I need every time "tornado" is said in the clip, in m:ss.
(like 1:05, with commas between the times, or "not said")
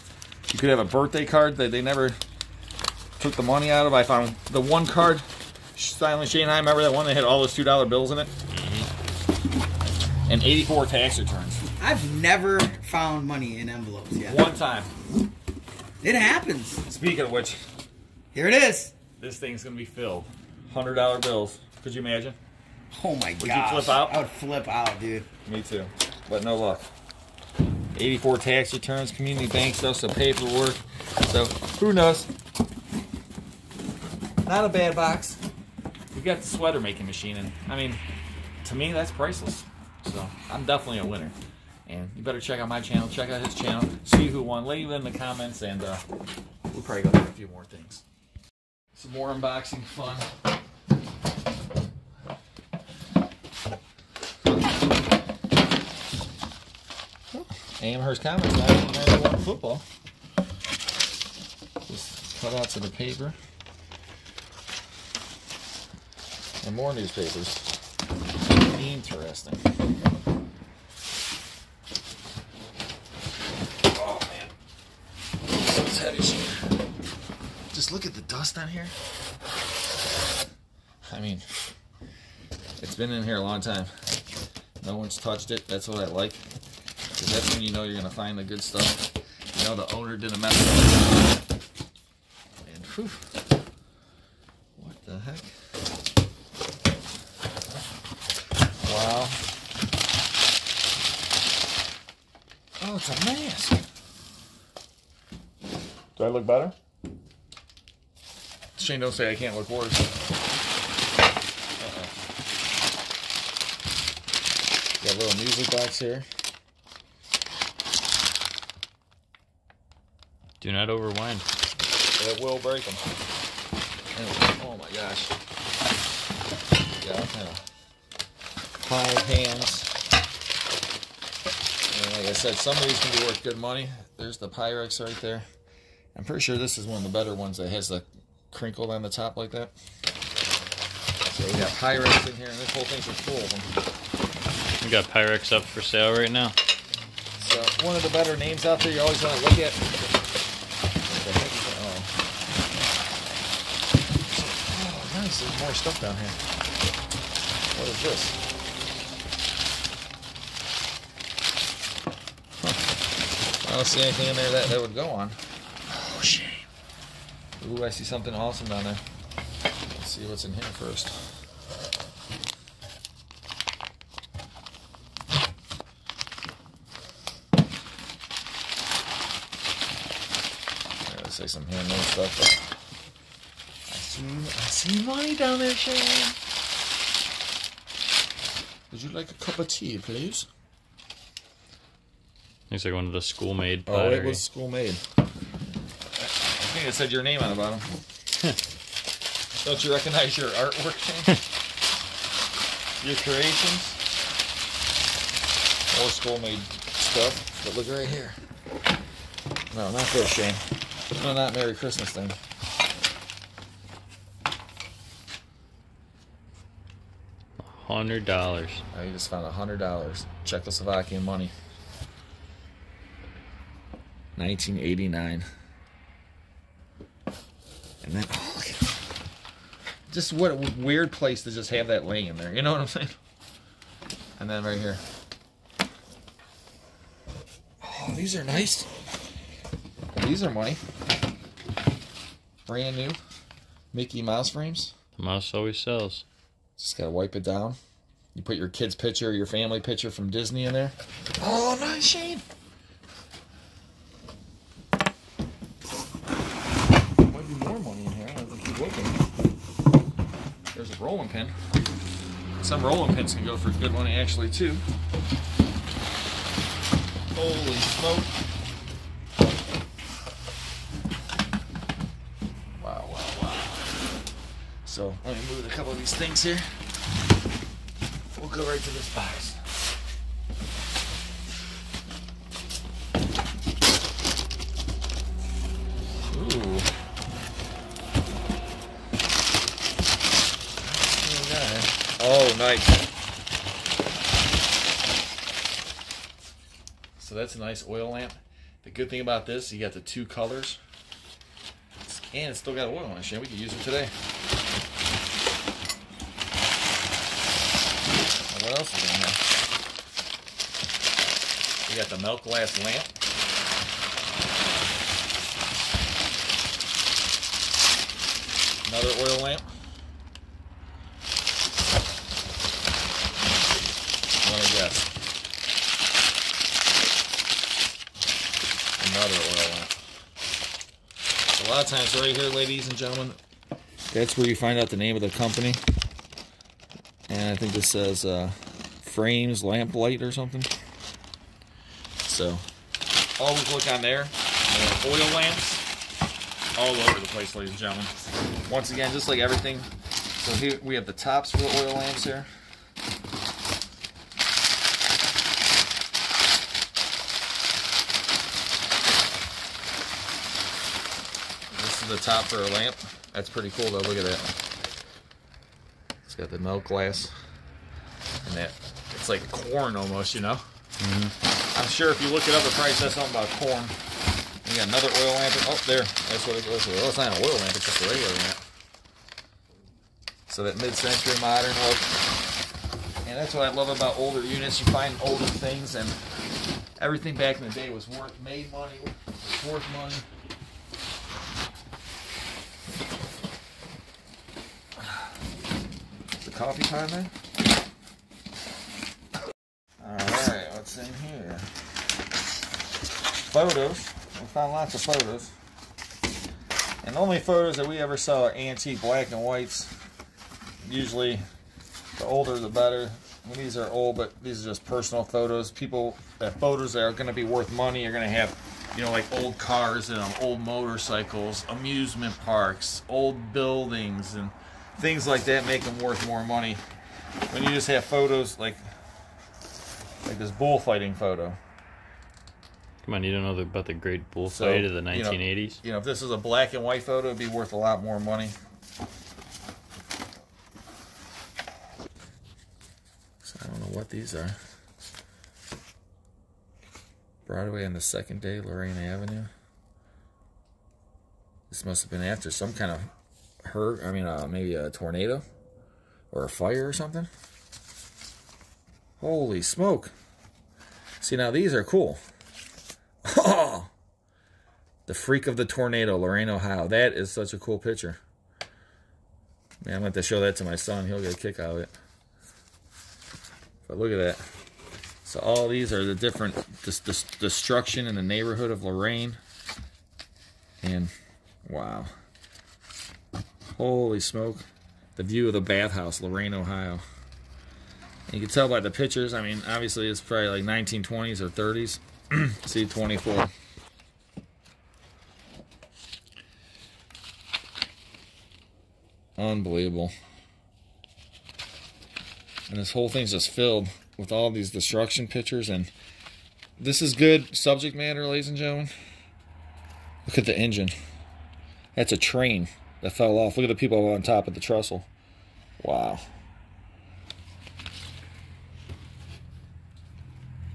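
7:34, 7:45.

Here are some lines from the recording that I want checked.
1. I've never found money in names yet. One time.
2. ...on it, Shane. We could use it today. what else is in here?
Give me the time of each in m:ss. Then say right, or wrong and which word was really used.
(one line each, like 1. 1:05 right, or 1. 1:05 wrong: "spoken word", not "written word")
1. 0:11 wrong: "envelopes", not "names"
2. 5:03 right.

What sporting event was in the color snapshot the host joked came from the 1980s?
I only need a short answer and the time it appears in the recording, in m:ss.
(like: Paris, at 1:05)
bullfighting, at 7:10.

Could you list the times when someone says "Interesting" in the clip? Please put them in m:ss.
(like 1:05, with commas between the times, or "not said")
1:08.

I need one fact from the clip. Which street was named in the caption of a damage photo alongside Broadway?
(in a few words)
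Lorain Avenue.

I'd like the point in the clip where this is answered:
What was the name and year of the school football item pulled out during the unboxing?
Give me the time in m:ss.
0:57.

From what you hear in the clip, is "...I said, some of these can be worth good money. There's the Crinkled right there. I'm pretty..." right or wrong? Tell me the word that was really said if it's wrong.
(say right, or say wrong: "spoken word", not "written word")
wrong: "Pyrex", not "Crinkled".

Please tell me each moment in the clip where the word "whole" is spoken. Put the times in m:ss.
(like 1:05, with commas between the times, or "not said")
2:22, 8:22.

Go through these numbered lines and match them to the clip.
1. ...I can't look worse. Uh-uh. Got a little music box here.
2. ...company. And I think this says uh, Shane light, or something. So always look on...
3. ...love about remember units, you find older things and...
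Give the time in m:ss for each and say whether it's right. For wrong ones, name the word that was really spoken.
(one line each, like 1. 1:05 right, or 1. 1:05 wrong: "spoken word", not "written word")
1. 1:49 right
2. 5:35 wrong: "Frames", not "Shane"
3. 6:23 wrong: "older", not "remember".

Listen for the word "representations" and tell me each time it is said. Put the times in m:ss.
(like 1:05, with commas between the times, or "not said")
not said.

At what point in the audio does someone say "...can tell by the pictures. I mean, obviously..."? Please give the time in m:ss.
8:08.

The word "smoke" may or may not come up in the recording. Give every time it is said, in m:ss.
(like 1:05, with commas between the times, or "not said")
4:27, 7:39, 8:04.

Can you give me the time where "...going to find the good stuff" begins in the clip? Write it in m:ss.
1:27.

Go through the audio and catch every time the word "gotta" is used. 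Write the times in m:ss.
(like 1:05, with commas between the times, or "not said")
3:01, 4:06.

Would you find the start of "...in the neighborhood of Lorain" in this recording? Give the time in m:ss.
7:58.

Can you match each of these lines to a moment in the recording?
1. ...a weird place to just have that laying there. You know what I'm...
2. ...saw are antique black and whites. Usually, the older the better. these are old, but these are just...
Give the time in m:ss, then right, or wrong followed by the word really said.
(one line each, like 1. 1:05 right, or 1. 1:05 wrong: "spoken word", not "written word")
1. 3:50 right
2. 6:48 right.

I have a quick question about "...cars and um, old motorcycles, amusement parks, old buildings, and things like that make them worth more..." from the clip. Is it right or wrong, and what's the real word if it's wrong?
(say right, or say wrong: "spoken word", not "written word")
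right.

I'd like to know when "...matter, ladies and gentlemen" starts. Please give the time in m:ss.
8:27.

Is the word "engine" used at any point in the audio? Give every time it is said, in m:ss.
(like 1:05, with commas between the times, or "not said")
8:30.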